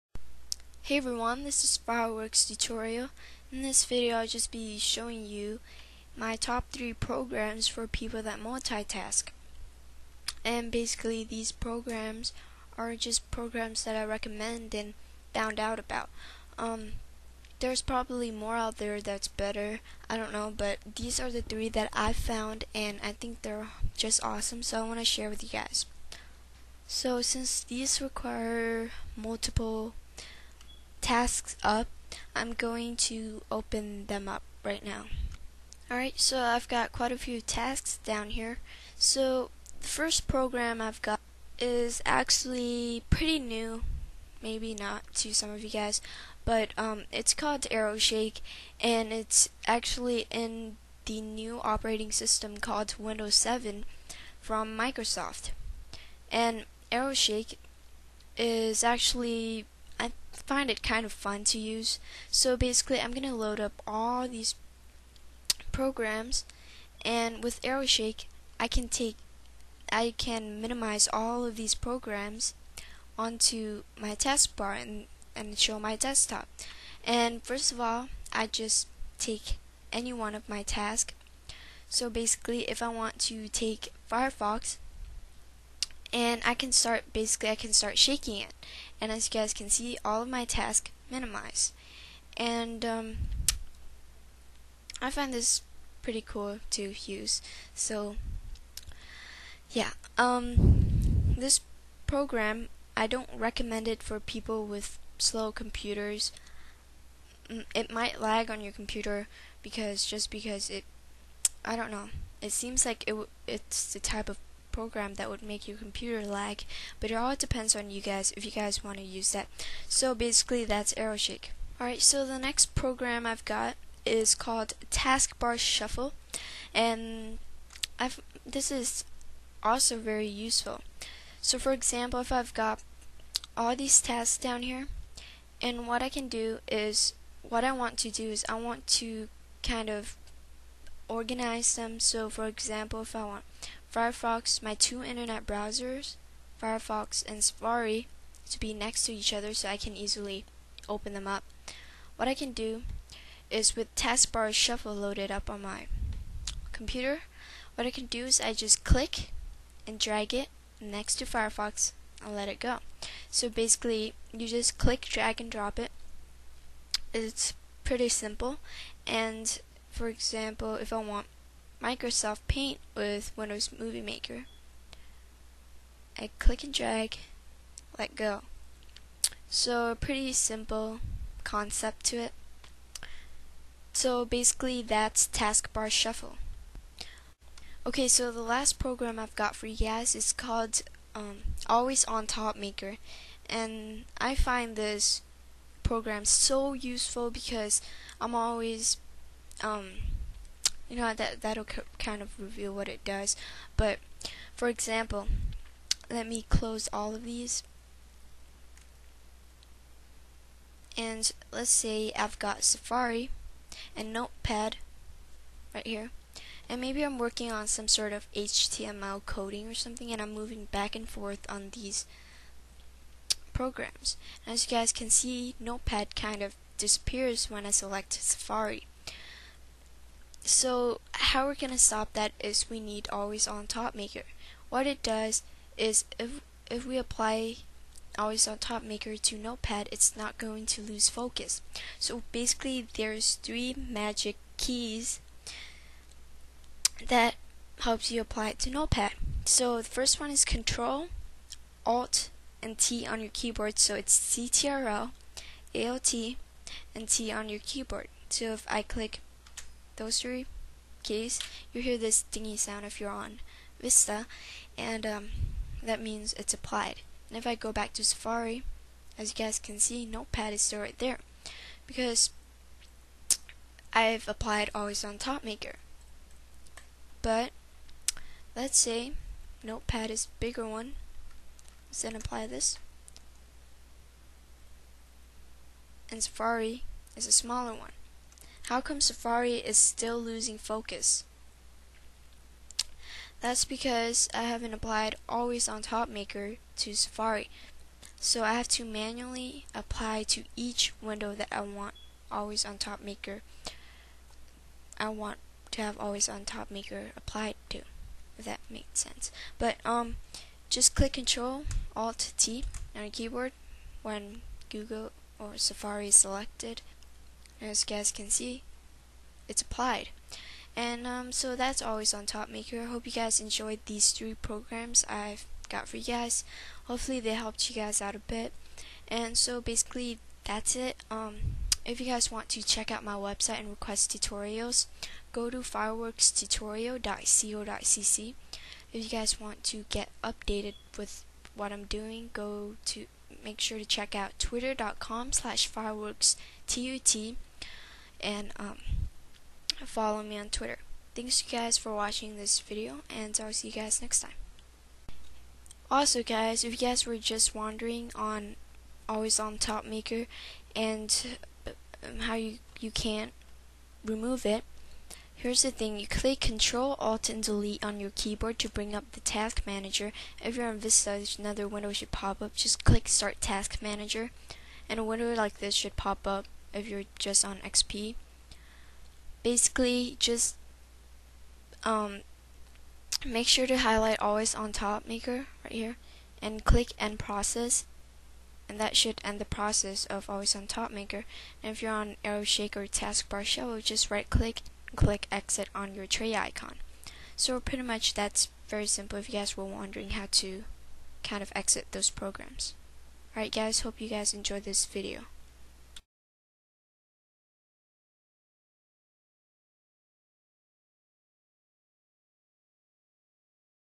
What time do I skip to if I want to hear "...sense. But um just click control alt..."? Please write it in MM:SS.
05:08.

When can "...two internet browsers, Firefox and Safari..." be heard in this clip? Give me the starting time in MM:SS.
02:24.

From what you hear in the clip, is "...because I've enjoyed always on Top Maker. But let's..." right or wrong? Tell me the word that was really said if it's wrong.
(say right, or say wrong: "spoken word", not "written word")
wrong: "applied", not "enjoyed".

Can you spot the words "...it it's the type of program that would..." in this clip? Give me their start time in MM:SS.
01:53.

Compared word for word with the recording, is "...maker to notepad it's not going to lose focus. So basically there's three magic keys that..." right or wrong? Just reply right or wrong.
right.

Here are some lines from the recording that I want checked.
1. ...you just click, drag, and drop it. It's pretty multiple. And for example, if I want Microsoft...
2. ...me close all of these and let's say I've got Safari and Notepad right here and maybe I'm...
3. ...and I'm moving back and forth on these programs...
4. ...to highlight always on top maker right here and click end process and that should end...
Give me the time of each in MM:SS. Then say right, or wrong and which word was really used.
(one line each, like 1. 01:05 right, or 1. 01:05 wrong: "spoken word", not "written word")
1. 02:44 wrong: "simple", not "multiple"
2. 03:26 right
3. 03:40 right
4. 06:23 right.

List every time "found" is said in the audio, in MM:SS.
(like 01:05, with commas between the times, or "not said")
00:15, 00:22.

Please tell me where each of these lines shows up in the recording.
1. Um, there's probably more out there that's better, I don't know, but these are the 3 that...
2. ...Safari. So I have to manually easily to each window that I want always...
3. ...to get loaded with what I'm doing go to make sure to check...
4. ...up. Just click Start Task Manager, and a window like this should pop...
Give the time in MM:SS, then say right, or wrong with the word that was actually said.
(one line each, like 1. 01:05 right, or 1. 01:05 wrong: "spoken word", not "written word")
1. 00:16 right
2. 04:56 wrong: "apply", not "easily"
3. 05:39 wrong: "updated", not "loaded"
4. 06:12 right.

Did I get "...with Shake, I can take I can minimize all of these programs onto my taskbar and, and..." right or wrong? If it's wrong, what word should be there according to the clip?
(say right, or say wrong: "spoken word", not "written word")
right.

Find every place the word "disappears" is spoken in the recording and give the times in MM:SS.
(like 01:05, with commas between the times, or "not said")
03:46.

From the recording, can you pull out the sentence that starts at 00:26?
So since these require multiple tasks up, I'm going to open them up right now.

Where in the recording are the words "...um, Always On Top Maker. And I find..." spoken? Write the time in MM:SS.
03:11.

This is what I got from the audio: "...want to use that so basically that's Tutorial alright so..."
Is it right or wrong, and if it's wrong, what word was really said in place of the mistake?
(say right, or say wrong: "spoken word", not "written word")
wrong: "AeroShake", not "Tutorial".